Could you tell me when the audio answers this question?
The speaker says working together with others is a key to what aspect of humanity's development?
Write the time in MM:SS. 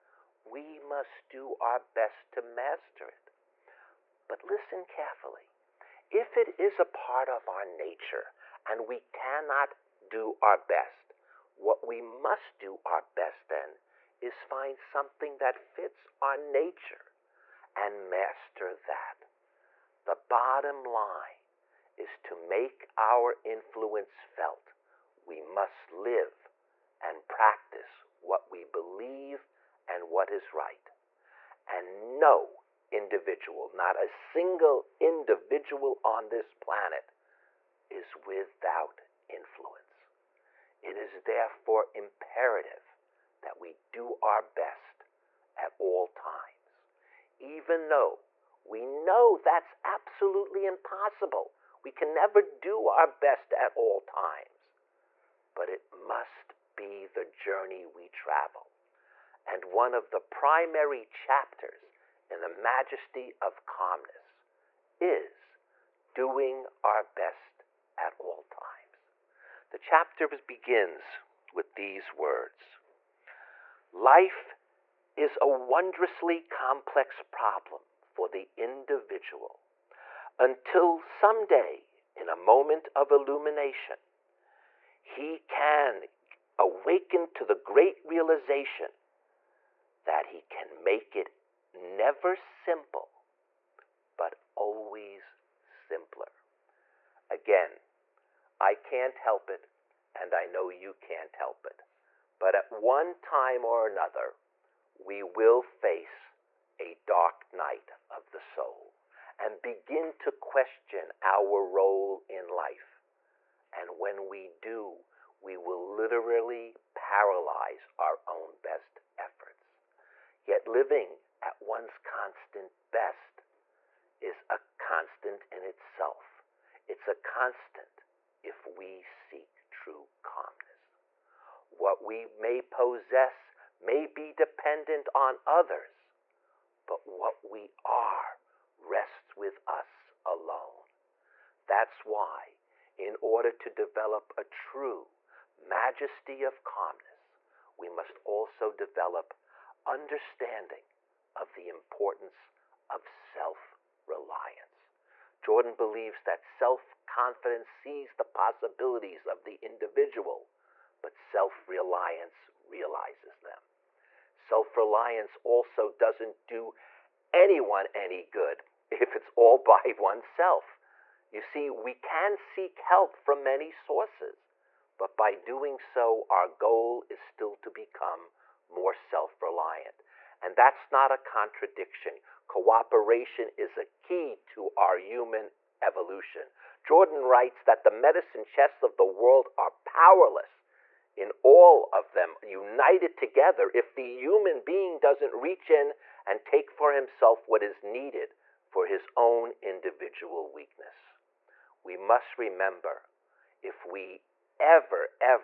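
03:04.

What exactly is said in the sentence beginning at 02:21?
That's why, in order to develop a true majesty of calmness, we must also develop understanding of the importance of self reliance.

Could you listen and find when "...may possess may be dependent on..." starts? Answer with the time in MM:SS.
02:12.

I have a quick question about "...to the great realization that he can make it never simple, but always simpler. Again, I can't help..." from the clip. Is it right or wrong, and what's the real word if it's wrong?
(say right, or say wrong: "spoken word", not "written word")
right.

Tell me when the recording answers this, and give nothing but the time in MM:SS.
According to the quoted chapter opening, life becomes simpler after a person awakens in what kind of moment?
01:22.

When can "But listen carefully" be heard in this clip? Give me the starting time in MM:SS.
00:04.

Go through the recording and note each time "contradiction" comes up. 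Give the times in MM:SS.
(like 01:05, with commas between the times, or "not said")
03:01.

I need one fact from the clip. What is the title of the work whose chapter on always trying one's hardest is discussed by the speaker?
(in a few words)
The Majesty of Calmness.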